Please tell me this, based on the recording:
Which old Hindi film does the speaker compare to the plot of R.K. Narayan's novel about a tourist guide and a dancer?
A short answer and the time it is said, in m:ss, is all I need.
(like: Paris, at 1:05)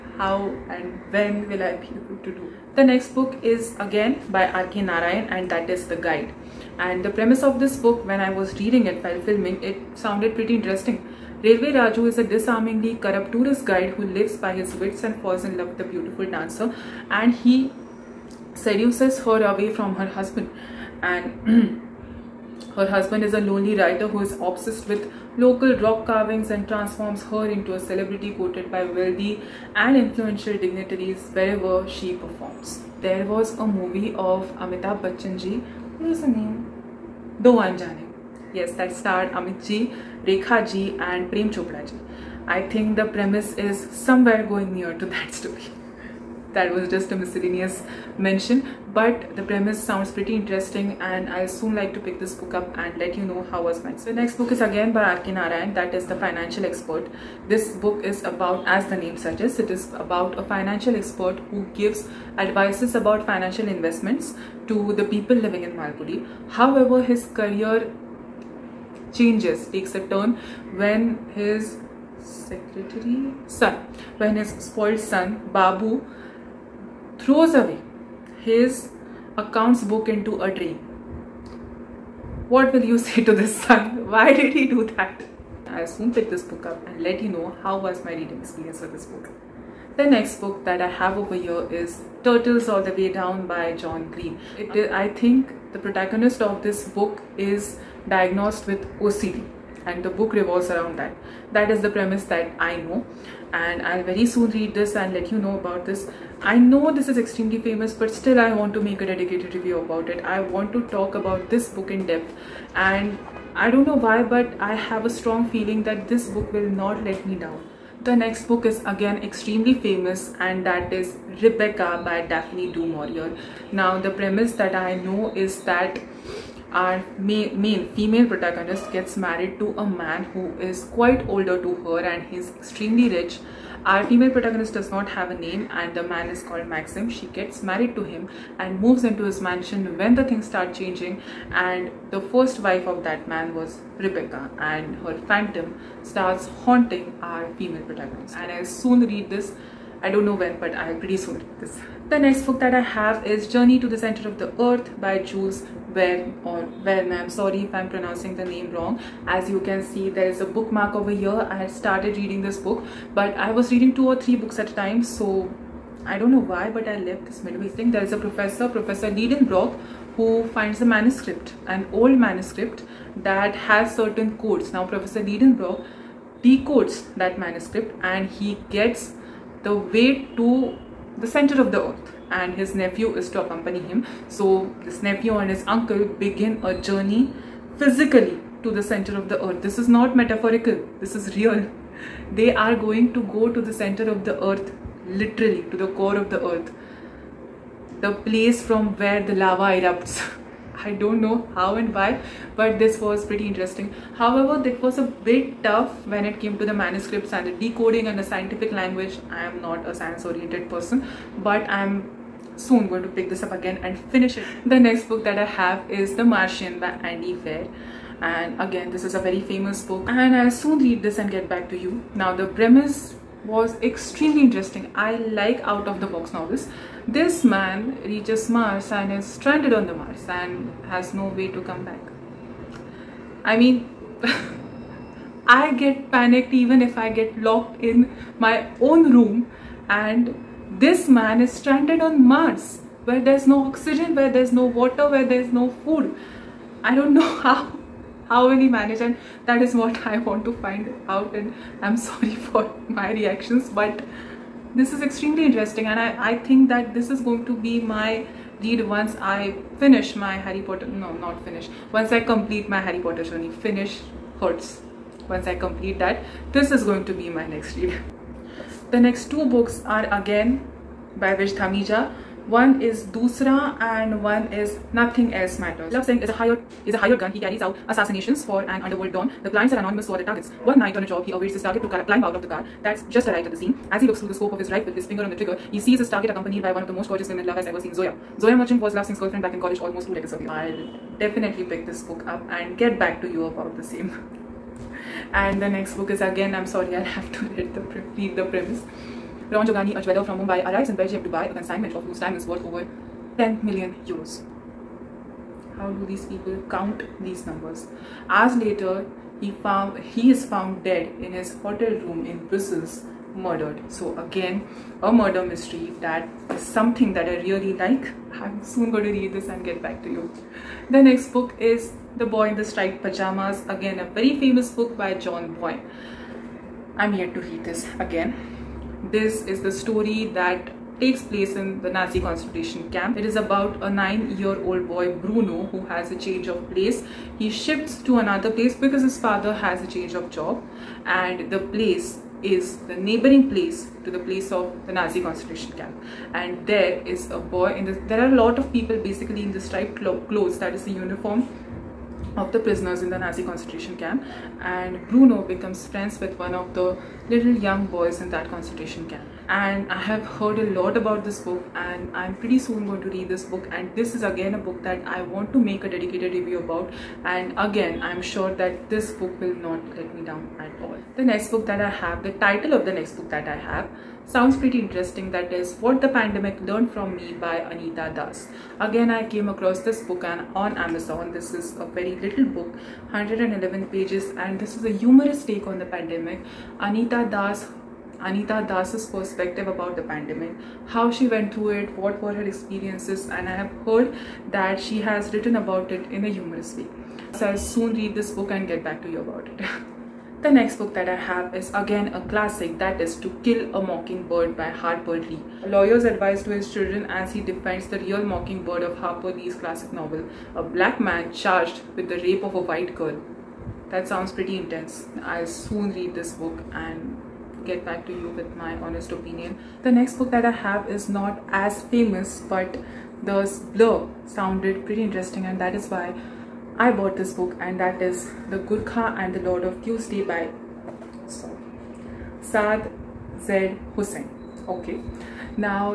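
Do Anjane, at 0:37.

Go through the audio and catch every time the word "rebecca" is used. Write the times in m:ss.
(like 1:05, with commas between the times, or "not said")
2:01, 2:23.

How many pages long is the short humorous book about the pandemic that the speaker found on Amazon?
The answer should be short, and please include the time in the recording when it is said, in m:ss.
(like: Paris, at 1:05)
111, at 6:23.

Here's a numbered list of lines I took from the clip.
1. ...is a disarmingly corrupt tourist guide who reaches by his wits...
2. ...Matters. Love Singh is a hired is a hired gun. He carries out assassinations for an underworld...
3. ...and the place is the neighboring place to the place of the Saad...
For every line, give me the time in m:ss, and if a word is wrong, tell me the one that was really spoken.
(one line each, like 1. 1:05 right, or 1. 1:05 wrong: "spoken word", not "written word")
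1. 0:12 wrong: "lives", not "reaches"
2. 4:35 right
3. 5:41 wrong: "Nazi", not "Saad".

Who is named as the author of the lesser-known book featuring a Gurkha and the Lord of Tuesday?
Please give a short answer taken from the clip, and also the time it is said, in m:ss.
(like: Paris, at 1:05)
Saad Z. Hussain, at 7:12.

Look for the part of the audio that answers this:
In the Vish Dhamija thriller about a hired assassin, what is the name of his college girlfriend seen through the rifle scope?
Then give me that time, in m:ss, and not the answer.
4:48.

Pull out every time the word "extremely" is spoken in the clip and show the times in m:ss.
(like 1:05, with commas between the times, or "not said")
1:47, 1:59, 2:12, 3:43, 4:15.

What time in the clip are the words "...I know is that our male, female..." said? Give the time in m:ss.
2:04.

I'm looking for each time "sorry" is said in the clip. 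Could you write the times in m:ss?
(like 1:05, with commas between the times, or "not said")
2:37, 4:12, 4:56.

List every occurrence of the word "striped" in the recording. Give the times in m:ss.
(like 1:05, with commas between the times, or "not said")
5:22, 5:49.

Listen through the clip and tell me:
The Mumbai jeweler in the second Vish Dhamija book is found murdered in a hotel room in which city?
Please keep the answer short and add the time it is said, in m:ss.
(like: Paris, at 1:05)
Brussels, at 5:12.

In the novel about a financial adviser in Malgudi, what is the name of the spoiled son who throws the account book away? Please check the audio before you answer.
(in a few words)
Babu.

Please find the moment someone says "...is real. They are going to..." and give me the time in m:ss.
3:11.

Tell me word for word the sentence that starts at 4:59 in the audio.
Ron Jogani, a jeweler from Mumbai, arrives in Belgium to buy a consignment of whose time is worth over 10 million euros.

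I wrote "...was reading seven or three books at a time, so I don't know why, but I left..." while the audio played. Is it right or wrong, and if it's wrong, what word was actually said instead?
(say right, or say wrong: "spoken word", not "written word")
wrong: "two", not "seven".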